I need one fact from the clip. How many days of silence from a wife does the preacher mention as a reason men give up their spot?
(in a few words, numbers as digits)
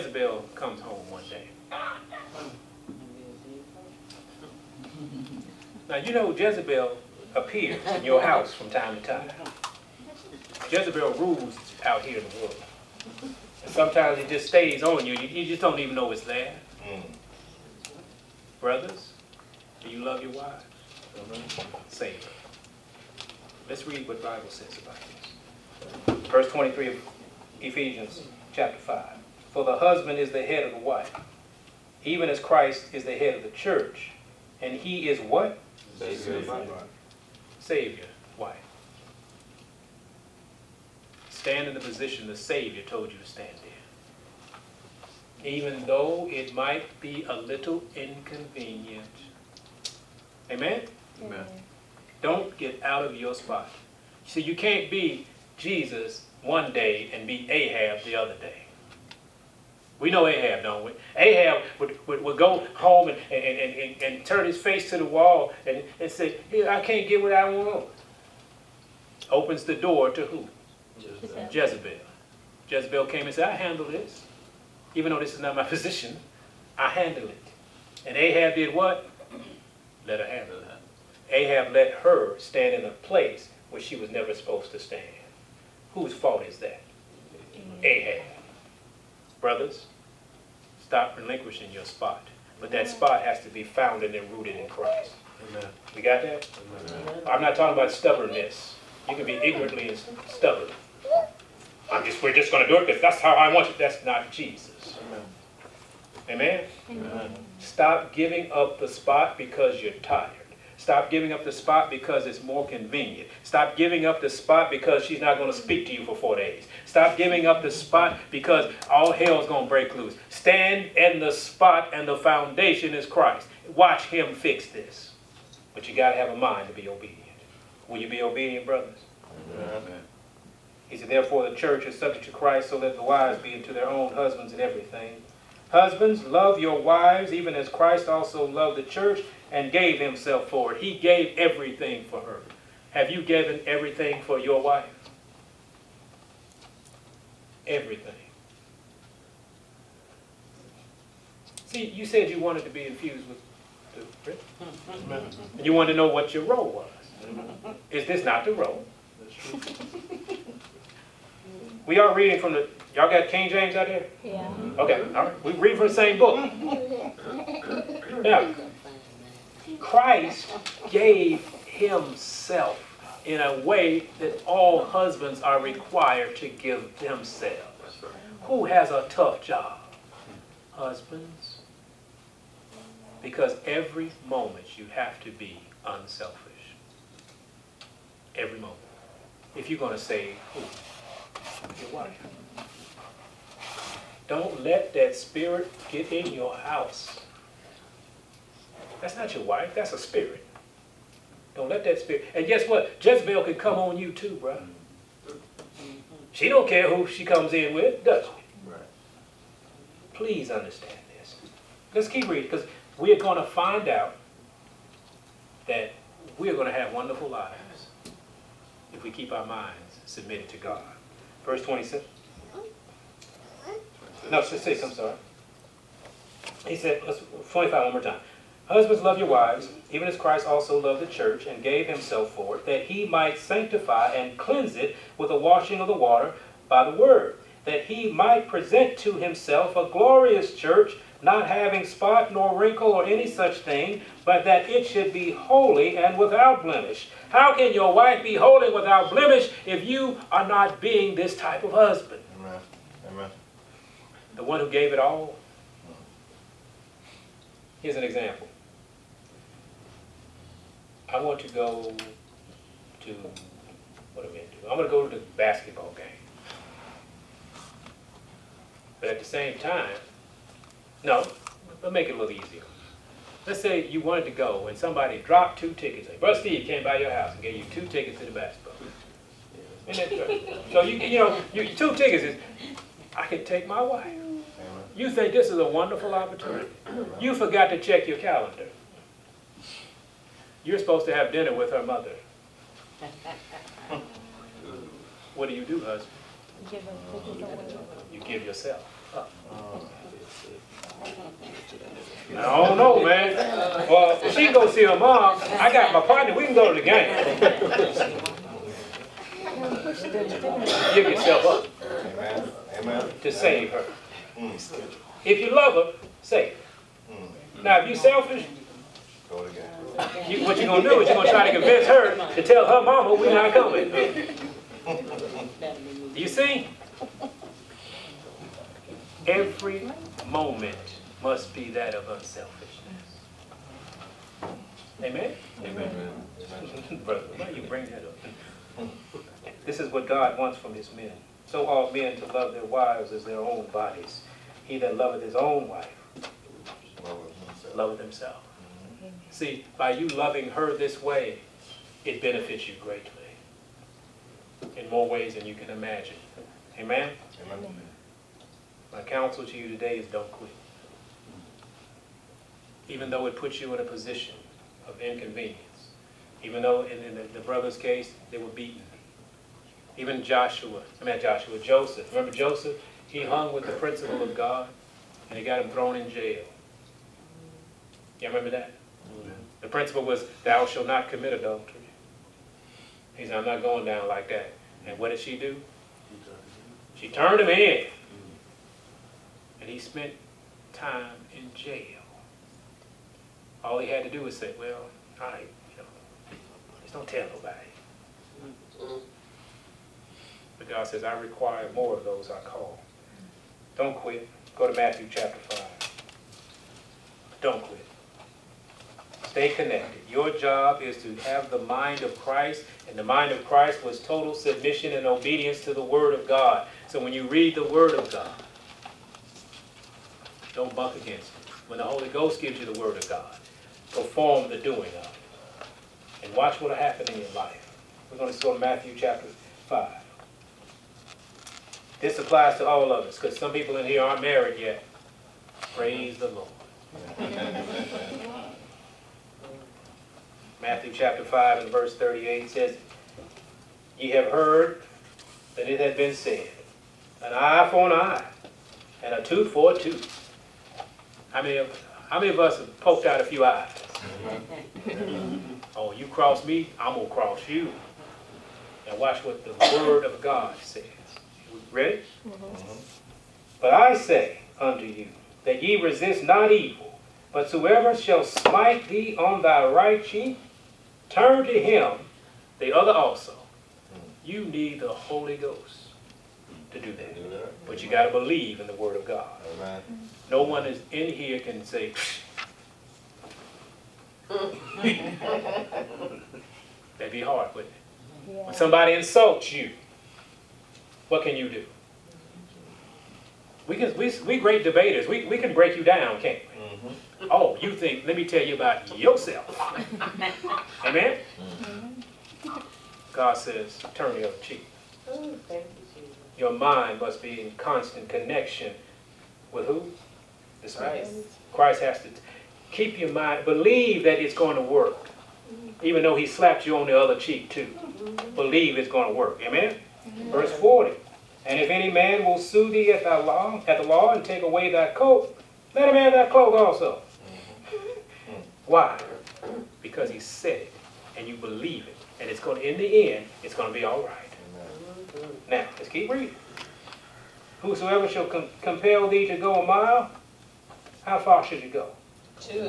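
4.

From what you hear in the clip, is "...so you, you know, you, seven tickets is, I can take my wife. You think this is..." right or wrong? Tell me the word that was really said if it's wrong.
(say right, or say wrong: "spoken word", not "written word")
wrong: "two", not "seven".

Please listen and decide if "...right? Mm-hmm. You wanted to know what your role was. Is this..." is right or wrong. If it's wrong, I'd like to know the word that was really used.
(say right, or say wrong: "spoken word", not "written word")
right.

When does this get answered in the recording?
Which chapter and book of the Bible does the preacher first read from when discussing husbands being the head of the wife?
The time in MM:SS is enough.
00:27.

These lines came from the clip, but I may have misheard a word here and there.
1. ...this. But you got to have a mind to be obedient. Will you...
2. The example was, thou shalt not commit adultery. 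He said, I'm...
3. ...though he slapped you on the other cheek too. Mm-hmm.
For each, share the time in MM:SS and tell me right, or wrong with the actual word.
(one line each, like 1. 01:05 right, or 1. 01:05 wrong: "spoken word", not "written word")
1. 02:04 right
2. 06:19 wrong: "principle", not "example"
3. 08:36 right.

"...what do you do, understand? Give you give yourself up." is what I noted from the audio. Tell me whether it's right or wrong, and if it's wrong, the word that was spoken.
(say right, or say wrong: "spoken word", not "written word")
wrong: "husband", not "understand".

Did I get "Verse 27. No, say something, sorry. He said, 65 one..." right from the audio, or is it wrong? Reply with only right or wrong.
wrong.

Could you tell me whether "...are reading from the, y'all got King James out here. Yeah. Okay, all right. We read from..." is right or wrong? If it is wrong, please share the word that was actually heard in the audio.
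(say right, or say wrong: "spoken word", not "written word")
right.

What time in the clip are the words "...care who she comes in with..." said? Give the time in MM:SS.
03:26.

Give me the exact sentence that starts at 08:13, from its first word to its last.
We can we we great debaters.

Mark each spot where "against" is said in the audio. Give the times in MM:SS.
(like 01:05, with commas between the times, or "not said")
07:00.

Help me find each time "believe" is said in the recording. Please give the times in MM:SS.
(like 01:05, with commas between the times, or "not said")
07:58, 08:33, 08:38, 08:51.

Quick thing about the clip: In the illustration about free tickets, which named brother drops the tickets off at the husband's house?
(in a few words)
Brother Steve.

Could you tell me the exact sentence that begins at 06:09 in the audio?
Even Joshua, I mean Joshua, Joseph.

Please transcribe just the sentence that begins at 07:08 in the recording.
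We're going to go to Matthew chapter 5.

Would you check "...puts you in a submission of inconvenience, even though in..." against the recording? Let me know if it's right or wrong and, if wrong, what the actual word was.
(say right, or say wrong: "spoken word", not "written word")
wrong: "position", not "submission".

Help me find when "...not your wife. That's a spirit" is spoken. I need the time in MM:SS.
03:19.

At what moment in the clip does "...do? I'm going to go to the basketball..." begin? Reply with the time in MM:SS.
04:24.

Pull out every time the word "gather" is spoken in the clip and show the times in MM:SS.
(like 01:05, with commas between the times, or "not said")
not said.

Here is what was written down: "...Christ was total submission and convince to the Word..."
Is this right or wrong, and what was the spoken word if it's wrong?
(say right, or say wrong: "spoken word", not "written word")
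wrong: "obedience", not "convince".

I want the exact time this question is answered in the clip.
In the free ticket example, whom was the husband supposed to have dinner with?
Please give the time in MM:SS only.
04:51.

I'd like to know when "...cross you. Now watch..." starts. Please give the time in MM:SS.
07:37.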